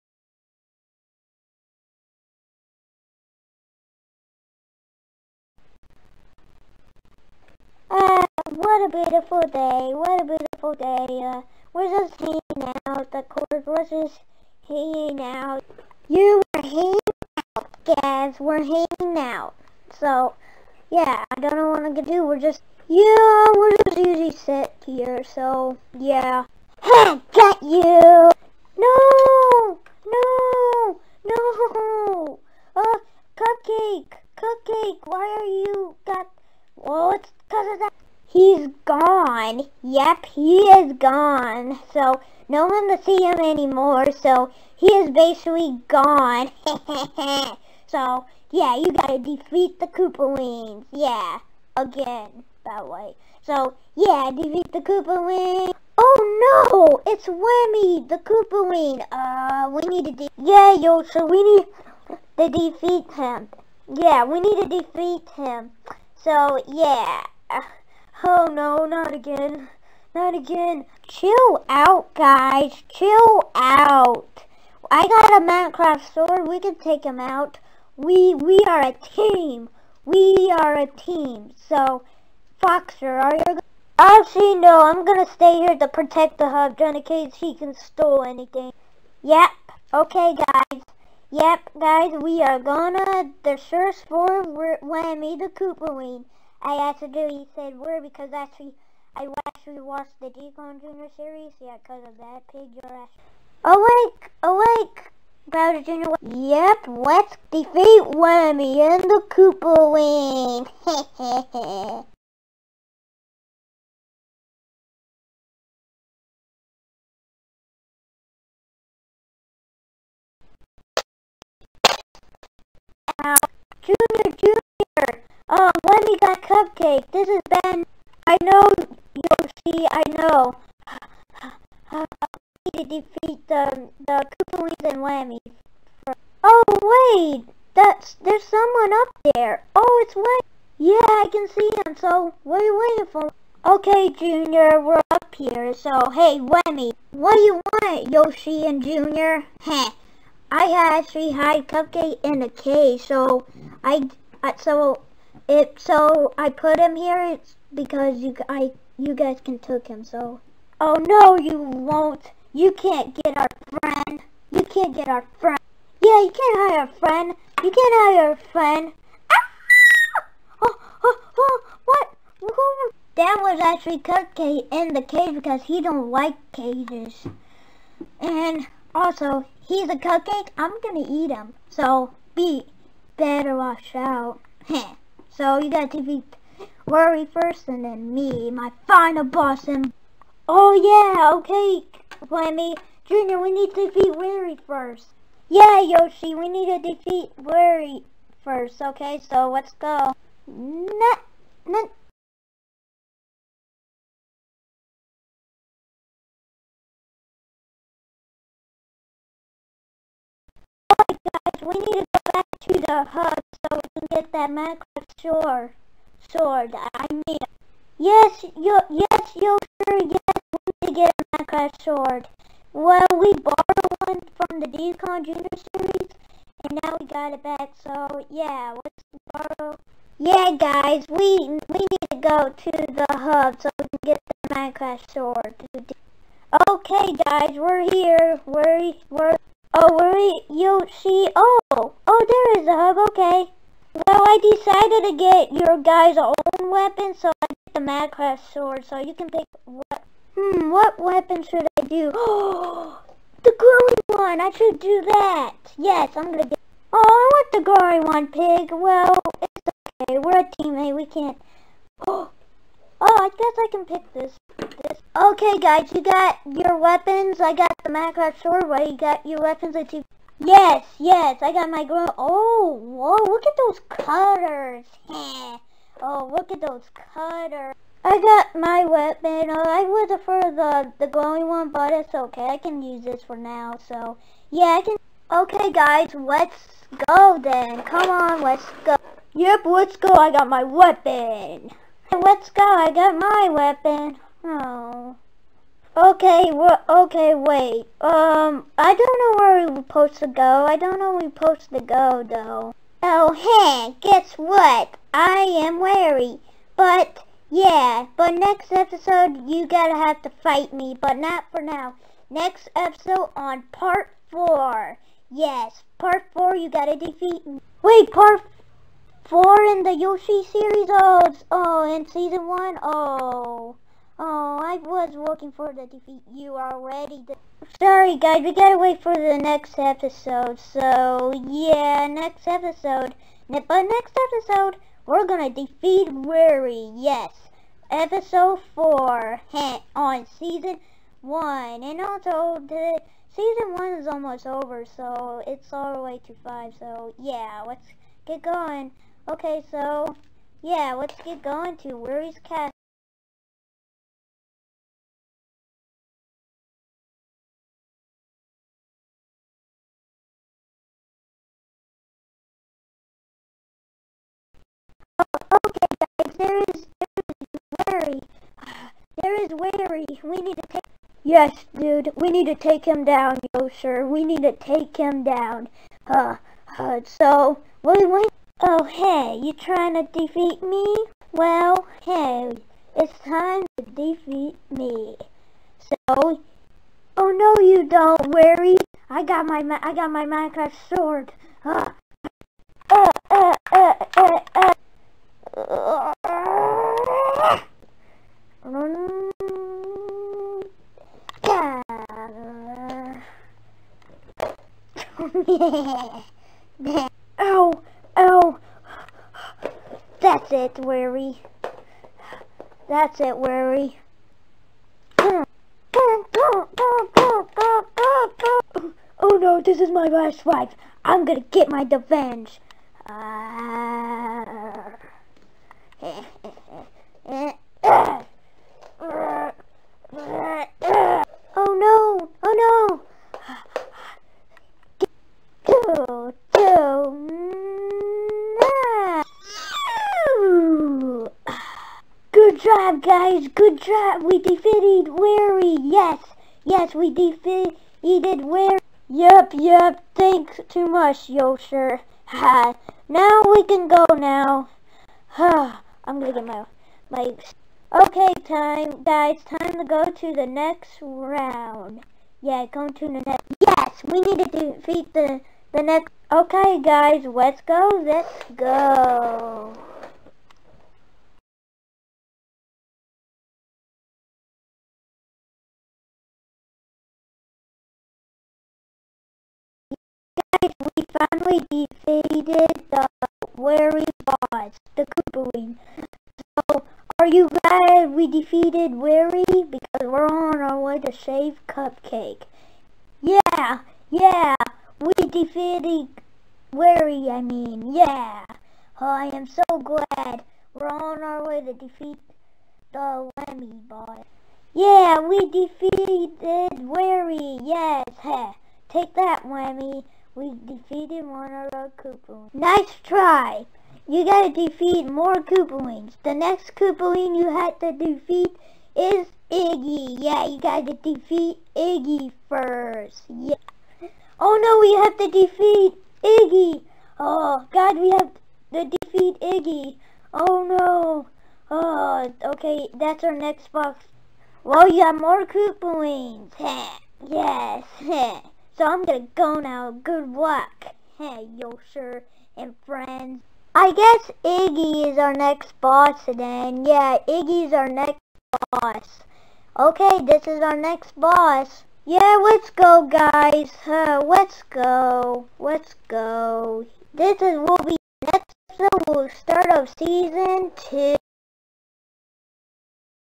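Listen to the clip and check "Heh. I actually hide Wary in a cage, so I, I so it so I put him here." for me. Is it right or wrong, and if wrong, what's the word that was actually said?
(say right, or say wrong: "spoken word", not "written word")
wrong: "Cupcake", not "Wary".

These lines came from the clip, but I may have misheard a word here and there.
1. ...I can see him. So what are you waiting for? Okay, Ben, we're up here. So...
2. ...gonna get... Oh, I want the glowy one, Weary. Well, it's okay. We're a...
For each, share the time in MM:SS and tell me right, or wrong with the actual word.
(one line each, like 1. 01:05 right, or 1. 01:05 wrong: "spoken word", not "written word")
1. 02:21 wrong: "Junior", not "Ben"
2. 04:16 wrong: "Pig", not "Weary".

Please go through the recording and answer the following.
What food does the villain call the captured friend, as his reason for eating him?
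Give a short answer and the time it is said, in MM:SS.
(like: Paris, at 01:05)
a cupcake, at 02:59.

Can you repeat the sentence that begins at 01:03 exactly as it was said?
Yeah, we need to defeat him.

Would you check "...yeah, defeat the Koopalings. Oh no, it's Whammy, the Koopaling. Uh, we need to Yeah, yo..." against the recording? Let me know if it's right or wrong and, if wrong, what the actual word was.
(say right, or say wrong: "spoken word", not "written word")
right.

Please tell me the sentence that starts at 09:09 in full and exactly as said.
Okay, this is our next boss.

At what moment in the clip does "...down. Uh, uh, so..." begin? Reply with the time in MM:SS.
06:15.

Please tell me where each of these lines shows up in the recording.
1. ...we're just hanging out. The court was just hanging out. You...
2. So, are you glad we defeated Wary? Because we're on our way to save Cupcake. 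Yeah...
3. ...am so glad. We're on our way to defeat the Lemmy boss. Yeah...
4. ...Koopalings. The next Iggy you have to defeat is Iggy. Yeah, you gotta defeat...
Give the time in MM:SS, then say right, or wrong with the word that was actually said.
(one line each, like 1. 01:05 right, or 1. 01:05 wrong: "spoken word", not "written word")
1. 00:11 right
2. 08:06 right
3. 08:19 right
4. 08:35 wrong: "Koopaling", not "Iggy".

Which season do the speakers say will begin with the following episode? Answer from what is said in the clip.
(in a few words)
season two.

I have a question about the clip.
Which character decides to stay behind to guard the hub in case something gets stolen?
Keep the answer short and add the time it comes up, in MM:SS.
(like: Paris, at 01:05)
Foxer, at 01:21.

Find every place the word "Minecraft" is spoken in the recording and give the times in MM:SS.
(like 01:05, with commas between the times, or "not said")
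01:15, 03:41, 03:54, 04:07, 04:27, 06:30.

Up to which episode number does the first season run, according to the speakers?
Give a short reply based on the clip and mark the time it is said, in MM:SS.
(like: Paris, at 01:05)
5, at 05:45.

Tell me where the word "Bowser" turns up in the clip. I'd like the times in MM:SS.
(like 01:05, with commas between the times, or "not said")
01:45.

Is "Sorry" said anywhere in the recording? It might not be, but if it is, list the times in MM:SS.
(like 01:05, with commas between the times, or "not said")
05:27.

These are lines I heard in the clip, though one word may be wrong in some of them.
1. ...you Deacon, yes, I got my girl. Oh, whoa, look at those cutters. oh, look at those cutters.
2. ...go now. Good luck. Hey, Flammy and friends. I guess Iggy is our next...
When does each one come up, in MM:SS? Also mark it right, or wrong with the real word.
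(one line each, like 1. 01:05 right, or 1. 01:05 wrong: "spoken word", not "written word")
1. 04:29 wrong: "Yes", not "Deacon"
2. 08:59 wrong: "Yosher", not "Flammy".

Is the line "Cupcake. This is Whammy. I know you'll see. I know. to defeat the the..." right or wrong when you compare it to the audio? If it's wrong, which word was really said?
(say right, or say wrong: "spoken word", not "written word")
wrong: "Ben", not "Whammy".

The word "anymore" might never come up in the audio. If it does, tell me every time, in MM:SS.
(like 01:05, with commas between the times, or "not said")
00:43.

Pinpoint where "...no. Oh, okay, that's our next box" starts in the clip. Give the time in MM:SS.
08:50.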